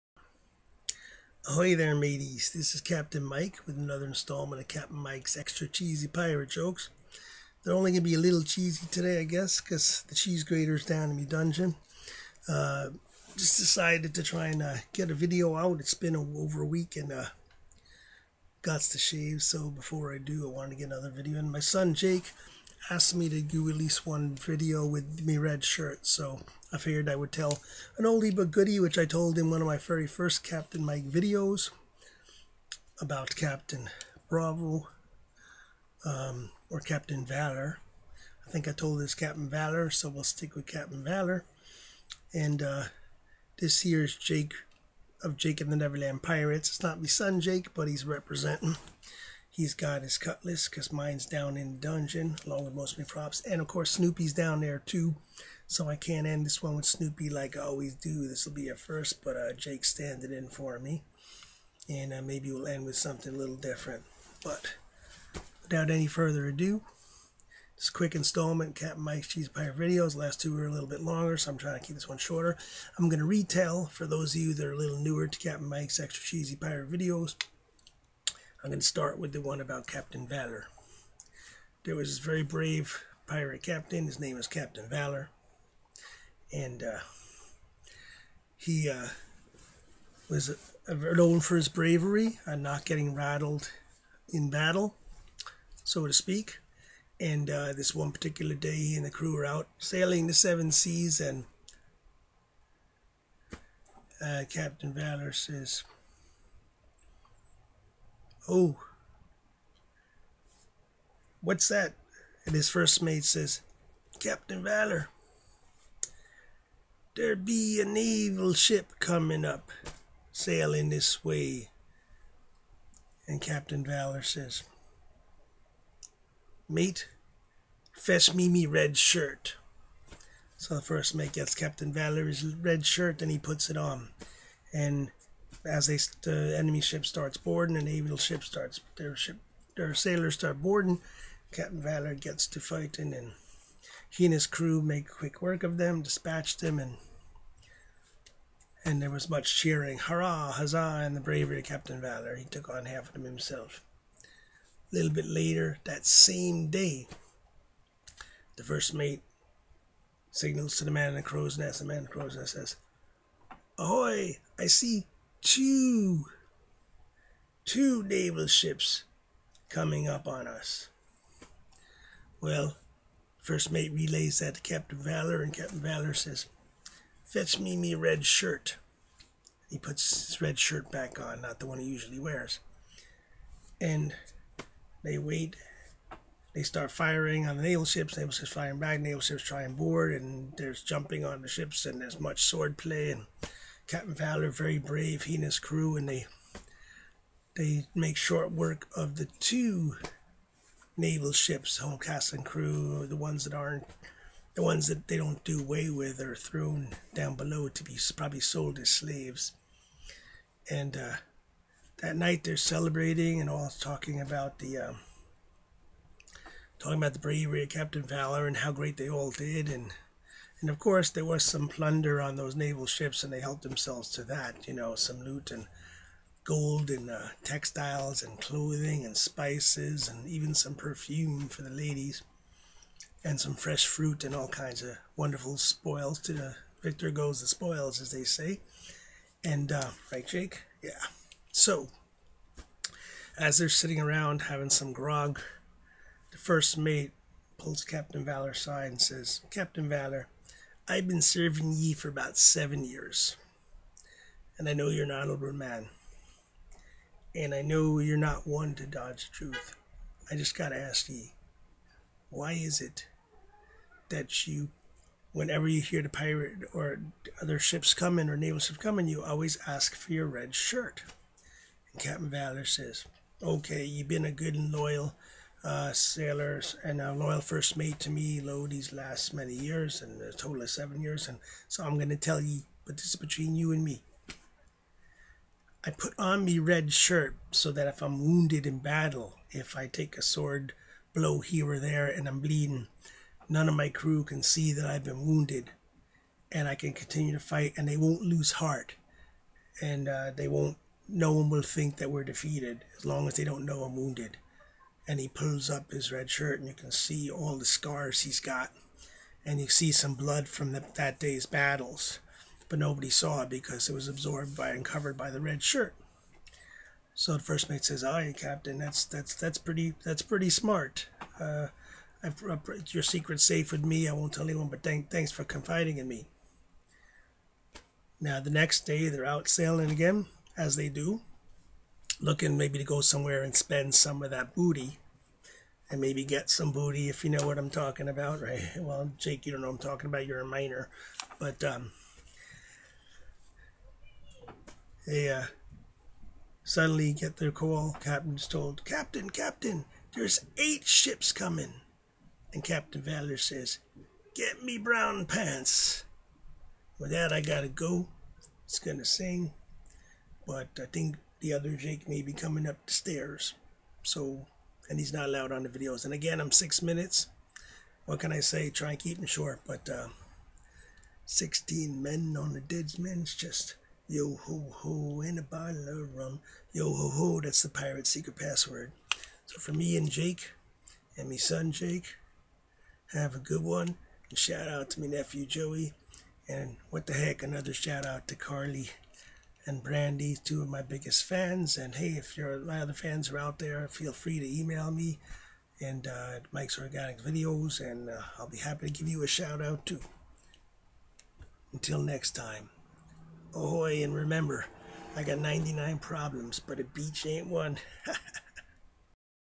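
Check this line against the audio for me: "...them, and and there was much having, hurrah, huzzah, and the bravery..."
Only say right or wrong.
wrong.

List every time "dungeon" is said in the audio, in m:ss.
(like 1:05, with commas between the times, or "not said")
0:11, 0:51.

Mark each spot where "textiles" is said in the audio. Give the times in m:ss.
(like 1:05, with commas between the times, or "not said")
3:47.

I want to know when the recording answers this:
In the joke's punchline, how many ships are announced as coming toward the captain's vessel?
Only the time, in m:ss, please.
5:50.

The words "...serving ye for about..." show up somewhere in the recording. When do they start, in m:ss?
4:11.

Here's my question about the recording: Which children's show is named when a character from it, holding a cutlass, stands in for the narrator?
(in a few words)
Jake and the Neverland Pirates.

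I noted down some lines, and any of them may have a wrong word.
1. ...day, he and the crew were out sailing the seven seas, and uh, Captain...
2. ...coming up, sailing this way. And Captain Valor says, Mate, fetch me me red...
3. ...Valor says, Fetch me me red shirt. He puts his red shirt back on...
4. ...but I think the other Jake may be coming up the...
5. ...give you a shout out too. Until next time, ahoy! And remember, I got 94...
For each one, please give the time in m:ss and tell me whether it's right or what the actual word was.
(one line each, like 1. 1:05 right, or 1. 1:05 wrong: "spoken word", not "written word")
1. 1:38 right
2. 1:58 right
3. 2:55 right
4. 6:00 right
5. 6:38 wrong: "99", not "94".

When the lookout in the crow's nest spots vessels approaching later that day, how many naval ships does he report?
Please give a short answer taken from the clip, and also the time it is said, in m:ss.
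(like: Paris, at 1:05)
2, at 2:45.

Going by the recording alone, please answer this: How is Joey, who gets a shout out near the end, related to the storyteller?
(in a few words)
nephew.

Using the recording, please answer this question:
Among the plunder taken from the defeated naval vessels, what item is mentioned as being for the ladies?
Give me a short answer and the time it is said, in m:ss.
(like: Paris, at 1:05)
perfume, at 3:50.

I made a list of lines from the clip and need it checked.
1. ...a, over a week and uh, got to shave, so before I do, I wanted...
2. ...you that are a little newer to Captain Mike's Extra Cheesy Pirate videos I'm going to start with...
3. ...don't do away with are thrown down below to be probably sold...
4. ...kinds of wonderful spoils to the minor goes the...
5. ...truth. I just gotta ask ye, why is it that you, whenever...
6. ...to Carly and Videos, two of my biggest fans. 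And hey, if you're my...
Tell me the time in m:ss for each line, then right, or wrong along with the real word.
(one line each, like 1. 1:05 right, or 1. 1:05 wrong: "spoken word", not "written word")
1. 0:16 right
2. 1:14 right
3. 3:25 right
4. 3:54 wrong: "victor", not "minor"
5. 4:19 right
6. 6:28 wrong: "Brandy", not "Videos".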